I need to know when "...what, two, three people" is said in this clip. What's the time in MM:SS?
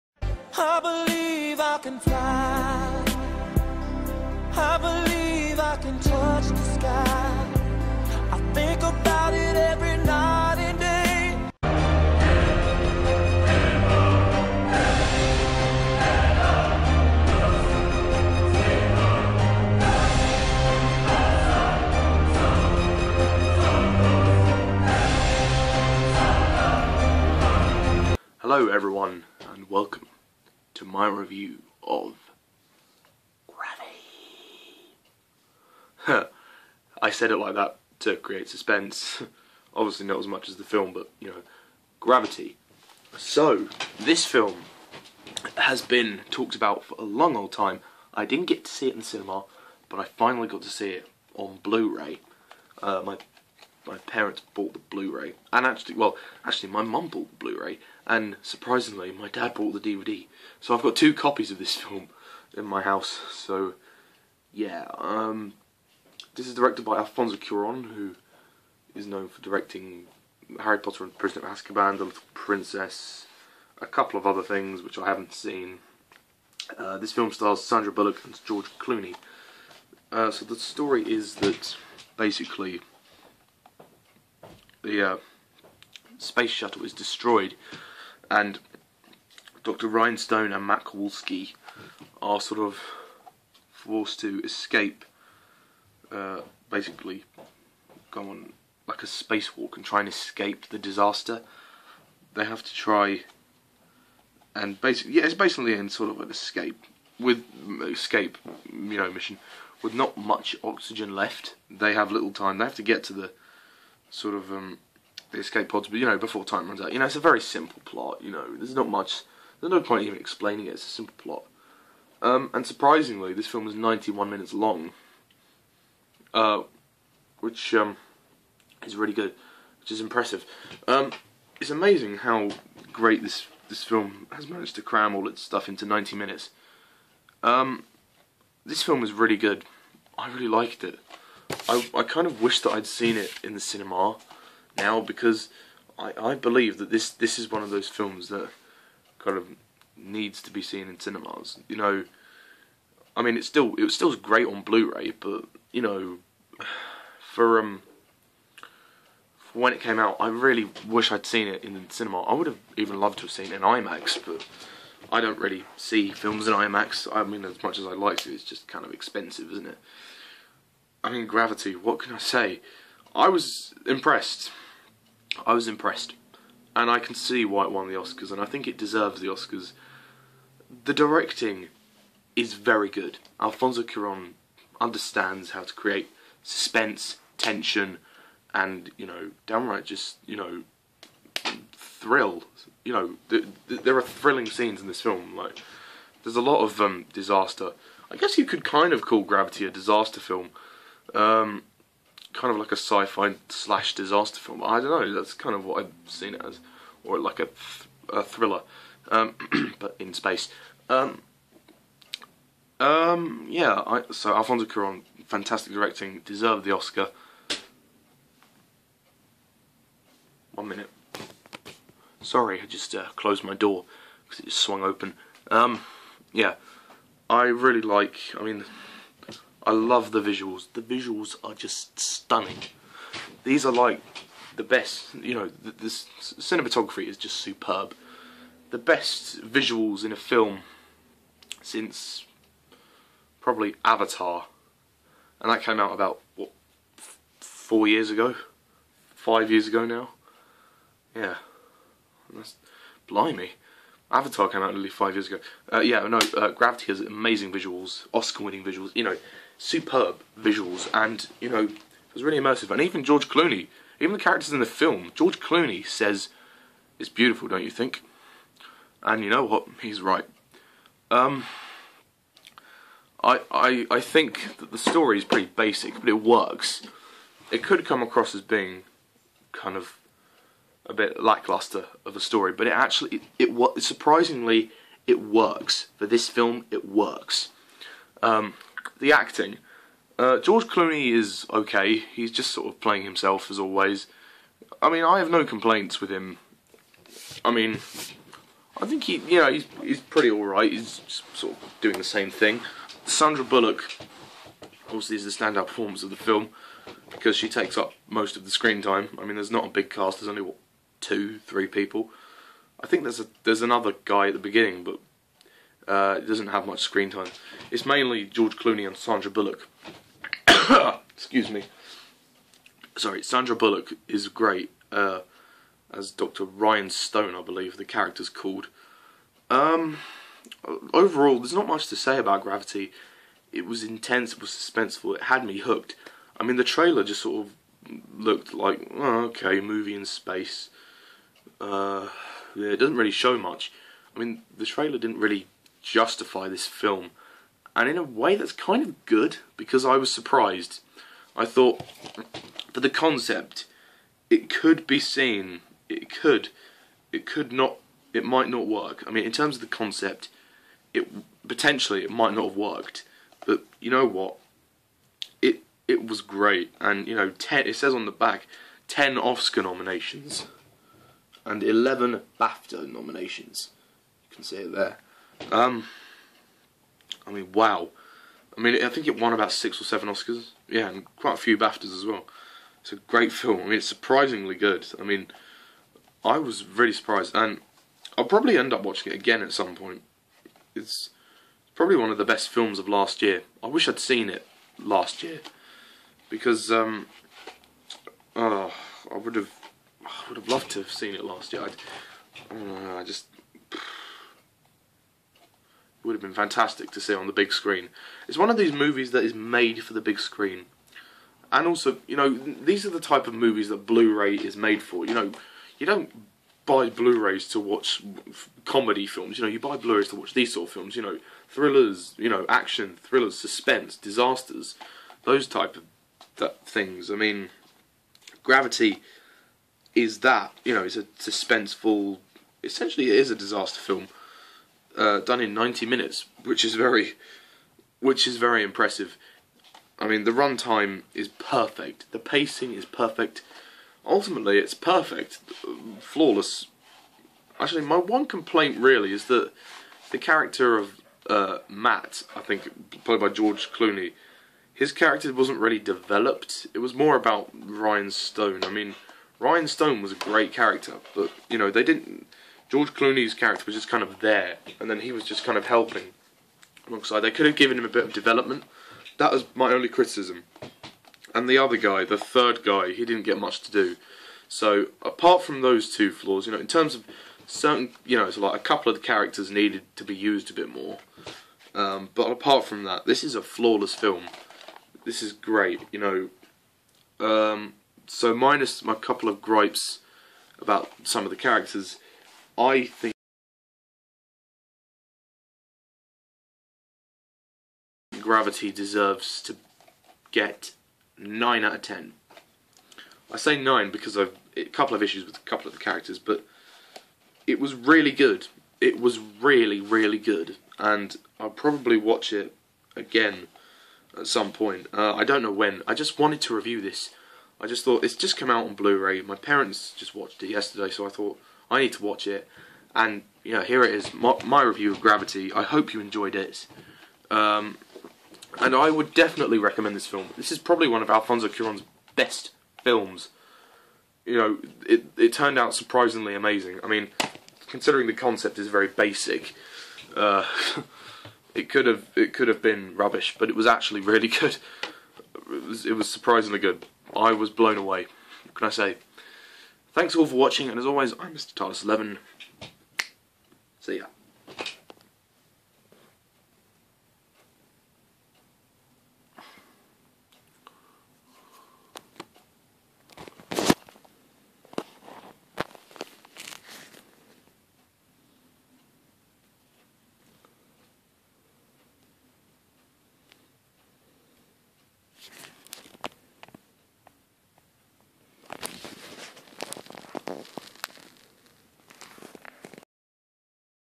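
05:10.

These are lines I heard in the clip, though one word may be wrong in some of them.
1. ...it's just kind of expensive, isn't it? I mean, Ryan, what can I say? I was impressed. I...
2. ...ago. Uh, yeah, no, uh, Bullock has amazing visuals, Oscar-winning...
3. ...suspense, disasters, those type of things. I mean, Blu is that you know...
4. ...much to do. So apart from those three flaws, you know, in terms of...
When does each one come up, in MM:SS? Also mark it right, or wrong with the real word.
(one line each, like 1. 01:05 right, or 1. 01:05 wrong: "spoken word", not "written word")
1. 02:48 wrong: "Gravity", not "Ryan"
2. 04:15 wrong: "Gravity", not "Bullock"
3. 07:03 wrong: "Gravity", not "Blu"
4. 07:53 wrong: "two", not "three".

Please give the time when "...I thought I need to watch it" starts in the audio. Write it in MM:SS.
08:41.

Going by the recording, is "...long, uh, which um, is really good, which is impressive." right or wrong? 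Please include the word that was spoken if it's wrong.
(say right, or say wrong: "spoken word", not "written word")
right.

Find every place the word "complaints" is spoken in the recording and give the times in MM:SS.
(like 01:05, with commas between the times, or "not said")
04:55, 07:28.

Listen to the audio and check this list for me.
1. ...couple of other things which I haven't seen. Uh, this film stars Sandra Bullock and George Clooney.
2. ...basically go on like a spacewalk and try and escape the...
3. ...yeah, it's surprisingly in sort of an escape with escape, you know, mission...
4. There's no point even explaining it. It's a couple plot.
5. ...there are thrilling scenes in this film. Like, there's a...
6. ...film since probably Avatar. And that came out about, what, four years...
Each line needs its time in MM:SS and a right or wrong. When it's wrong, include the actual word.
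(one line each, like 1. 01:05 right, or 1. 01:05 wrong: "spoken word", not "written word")
1. 01:13 right
2. 01:36 right
3. 01:45 wrong: "basically", not "surprisingly"
4. 01:59 wrong: "simple", not "couple"
5. 03:13 right
6. 04:00 right.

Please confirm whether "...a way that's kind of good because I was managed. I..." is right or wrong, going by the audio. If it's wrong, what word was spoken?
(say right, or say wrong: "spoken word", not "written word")
wrong: "surprised", not "managed".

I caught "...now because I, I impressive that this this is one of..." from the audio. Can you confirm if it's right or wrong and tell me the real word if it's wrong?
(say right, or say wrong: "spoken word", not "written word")
wrong: "believe", not "impressive".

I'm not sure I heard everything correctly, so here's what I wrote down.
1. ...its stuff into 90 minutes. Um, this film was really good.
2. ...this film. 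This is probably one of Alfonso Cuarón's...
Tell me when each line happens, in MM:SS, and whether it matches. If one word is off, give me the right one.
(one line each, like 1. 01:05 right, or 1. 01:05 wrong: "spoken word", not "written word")
1. 02:15 right
2. 08:49 right.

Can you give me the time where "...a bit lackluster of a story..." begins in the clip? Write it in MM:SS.
04:40.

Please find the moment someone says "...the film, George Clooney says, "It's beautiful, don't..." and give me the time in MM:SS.
04:24.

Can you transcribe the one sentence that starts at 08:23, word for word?
I say 9 because I've a couple of issues with a couple of the characters, but it was really good.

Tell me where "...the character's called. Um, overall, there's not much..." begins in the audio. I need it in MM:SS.
05:27.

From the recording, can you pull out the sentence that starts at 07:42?
George Clooney's character was just kind of there, and then he was just kind of helping alongside.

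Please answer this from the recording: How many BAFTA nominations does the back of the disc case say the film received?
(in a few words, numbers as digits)
11.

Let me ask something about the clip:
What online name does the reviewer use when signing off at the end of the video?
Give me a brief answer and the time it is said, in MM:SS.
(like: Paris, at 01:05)
Tardis Titus11, at 09:11.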